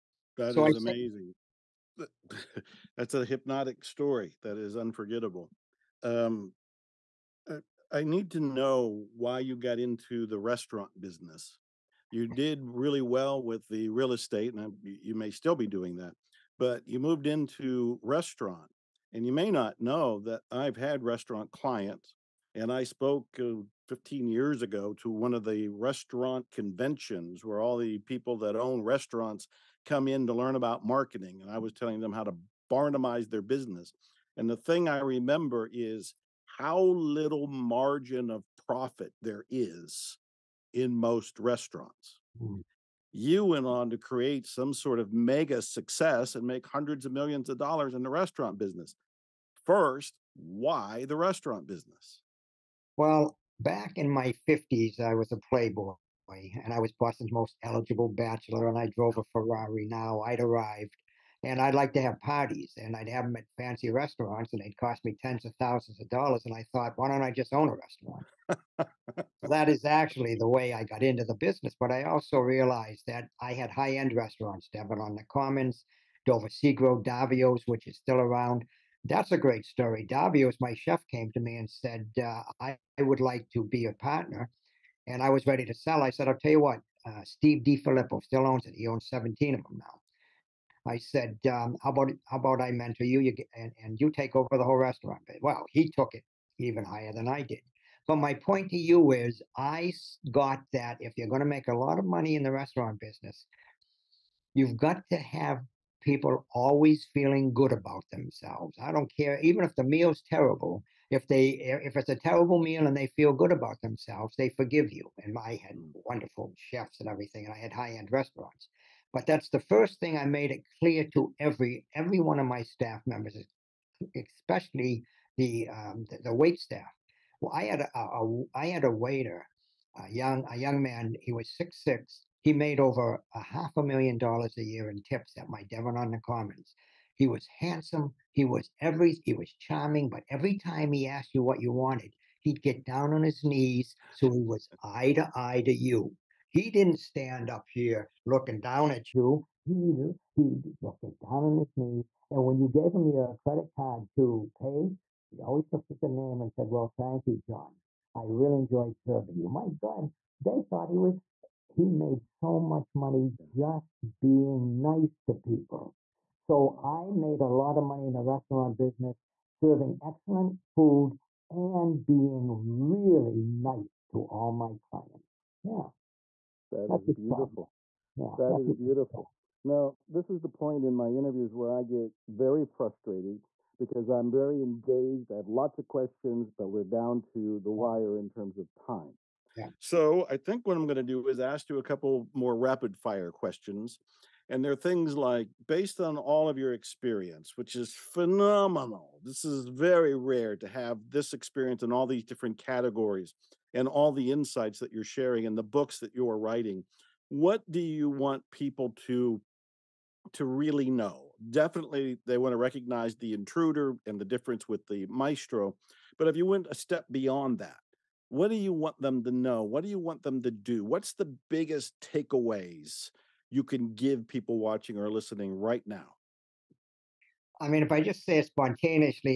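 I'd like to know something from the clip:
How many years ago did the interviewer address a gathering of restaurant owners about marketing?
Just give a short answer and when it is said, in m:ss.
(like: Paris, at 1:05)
15, at 0:23.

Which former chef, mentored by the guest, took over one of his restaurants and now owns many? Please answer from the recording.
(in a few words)
Steve DiFilippo.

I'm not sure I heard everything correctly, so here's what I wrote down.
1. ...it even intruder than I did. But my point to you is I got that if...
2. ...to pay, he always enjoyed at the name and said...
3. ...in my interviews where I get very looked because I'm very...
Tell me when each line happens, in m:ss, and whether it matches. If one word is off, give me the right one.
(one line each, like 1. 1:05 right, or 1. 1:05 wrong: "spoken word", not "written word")
1. 1:36 wrong: "higher", not "intruder"
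2. 2:34 wrong: "looked", not "enjoyed"
3. 3:00 wrong: "frustrated", not "looked".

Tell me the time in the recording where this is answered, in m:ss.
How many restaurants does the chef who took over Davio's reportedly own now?
1:29.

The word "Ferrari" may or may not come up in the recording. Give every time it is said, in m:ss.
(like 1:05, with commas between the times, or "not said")
0:59.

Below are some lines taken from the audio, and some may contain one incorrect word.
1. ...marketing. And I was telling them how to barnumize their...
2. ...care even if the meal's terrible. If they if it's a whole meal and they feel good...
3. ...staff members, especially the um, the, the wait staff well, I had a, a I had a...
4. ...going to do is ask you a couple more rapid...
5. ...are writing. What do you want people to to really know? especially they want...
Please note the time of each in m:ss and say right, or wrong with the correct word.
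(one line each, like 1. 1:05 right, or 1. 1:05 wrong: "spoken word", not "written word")
1. 0:30 right
2. 1:49 wrong: "terrible", not "whole"
3. 2:02 right
4. 3:10 right
5. 3:26 wrong: "definitely", not "especially".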